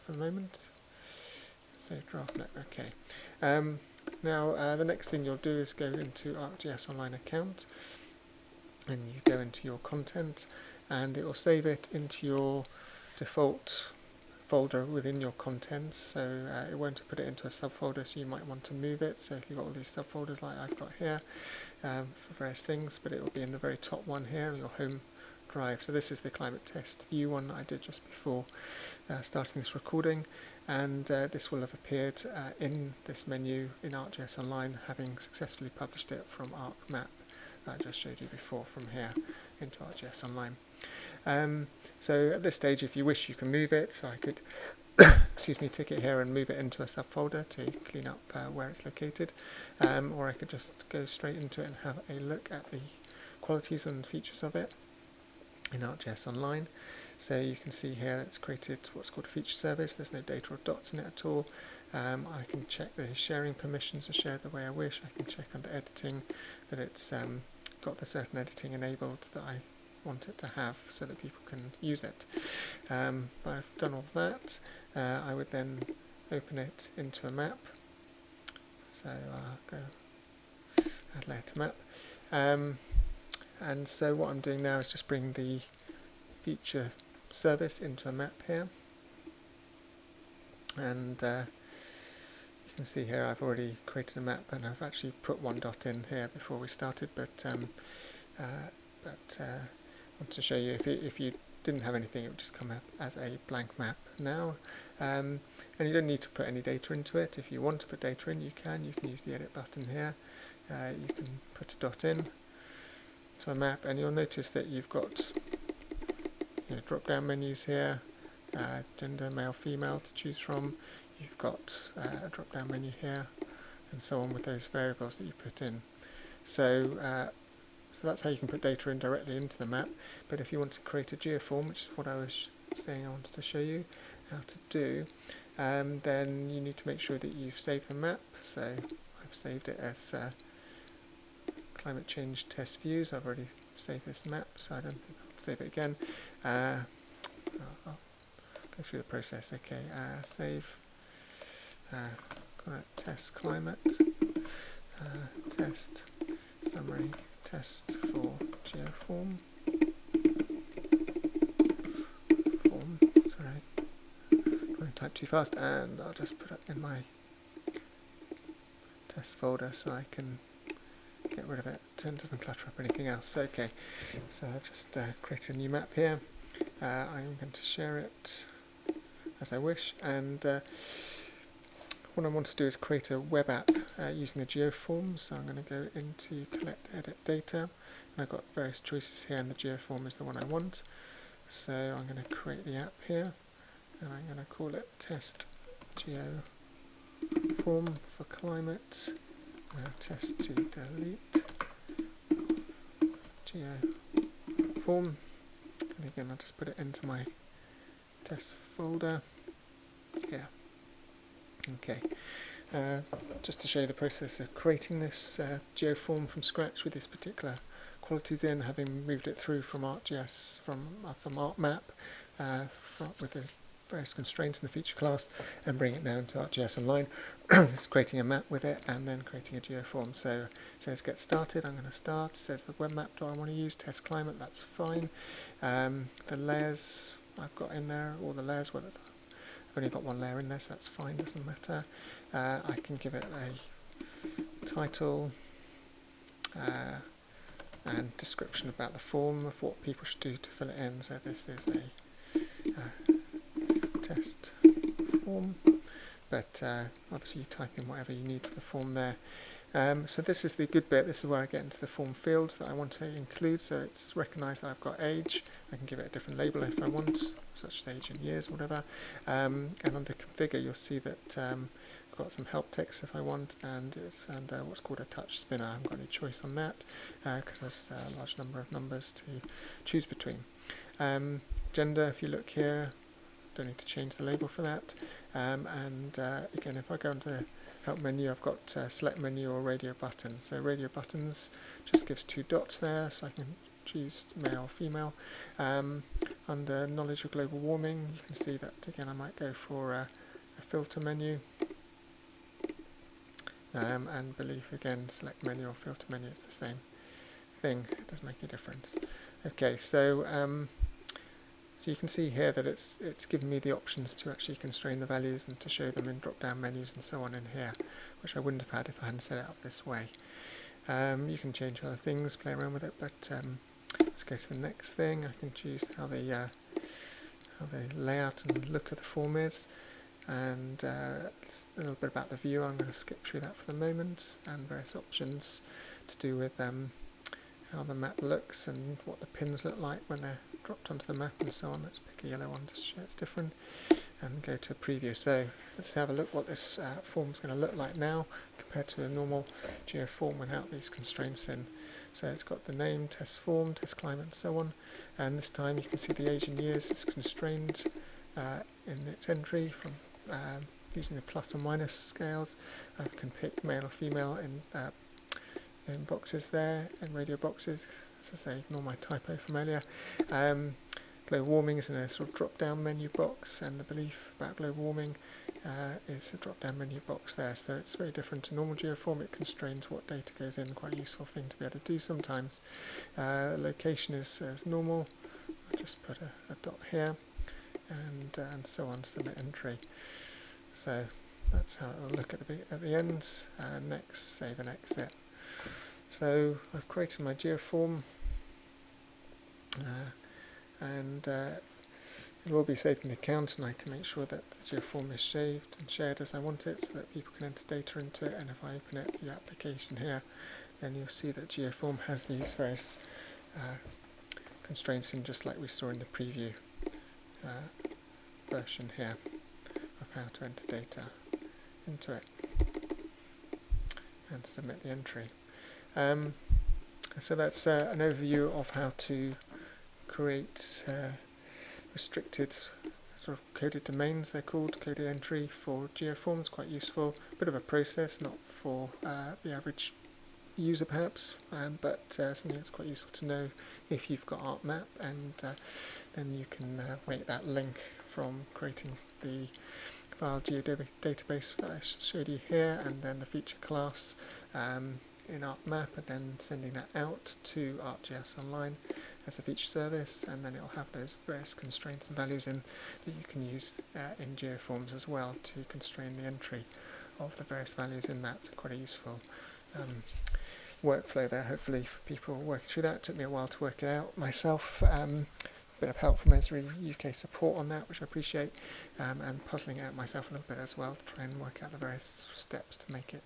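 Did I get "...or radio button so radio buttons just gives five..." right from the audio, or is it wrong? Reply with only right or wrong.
wrong.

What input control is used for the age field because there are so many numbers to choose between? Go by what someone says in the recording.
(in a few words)
touch spinner.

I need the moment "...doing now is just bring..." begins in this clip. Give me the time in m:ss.
1:24.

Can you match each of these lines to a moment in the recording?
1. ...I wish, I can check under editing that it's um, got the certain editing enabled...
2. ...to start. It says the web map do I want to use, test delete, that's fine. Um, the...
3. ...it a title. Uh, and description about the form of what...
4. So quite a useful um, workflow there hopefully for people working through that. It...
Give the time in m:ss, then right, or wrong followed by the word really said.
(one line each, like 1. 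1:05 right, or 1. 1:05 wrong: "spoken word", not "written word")
1. 1:04 right
2. 3:51 wrong: "climate", not "delete"
3. 4:03 right
4. 7:48 right.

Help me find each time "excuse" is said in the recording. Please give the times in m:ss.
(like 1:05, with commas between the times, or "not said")
0:45.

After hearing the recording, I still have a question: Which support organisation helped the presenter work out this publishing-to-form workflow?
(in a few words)
Esri UK support.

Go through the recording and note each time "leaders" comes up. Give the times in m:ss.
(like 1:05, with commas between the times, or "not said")
not said.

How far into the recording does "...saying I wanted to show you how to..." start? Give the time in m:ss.
2:12.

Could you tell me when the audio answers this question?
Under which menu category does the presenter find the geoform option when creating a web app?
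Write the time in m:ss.
3:06.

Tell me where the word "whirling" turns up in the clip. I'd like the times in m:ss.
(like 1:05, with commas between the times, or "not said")
not said.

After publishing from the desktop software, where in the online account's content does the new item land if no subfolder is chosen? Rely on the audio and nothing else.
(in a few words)
default folder.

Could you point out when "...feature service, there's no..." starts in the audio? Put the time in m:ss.
0:59.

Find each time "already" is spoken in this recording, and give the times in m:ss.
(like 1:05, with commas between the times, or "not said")
1:33, 2:23.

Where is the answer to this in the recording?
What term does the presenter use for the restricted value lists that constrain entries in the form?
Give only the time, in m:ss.
7:13.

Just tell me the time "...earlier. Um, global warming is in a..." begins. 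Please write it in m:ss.
6:09.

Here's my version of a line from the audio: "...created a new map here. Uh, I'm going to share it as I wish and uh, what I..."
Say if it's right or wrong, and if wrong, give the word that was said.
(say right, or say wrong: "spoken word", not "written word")
right.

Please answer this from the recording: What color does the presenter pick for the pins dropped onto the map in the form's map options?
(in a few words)
yellow.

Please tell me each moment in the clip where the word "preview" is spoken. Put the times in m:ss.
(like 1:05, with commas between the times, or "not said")
5:44, 6:56.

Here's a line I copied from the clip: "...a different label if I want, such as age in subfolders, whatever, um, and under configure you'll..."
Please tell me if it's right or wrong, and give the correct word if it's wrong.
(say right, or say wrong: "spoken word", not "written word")
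wrong: "years", not "subfolders".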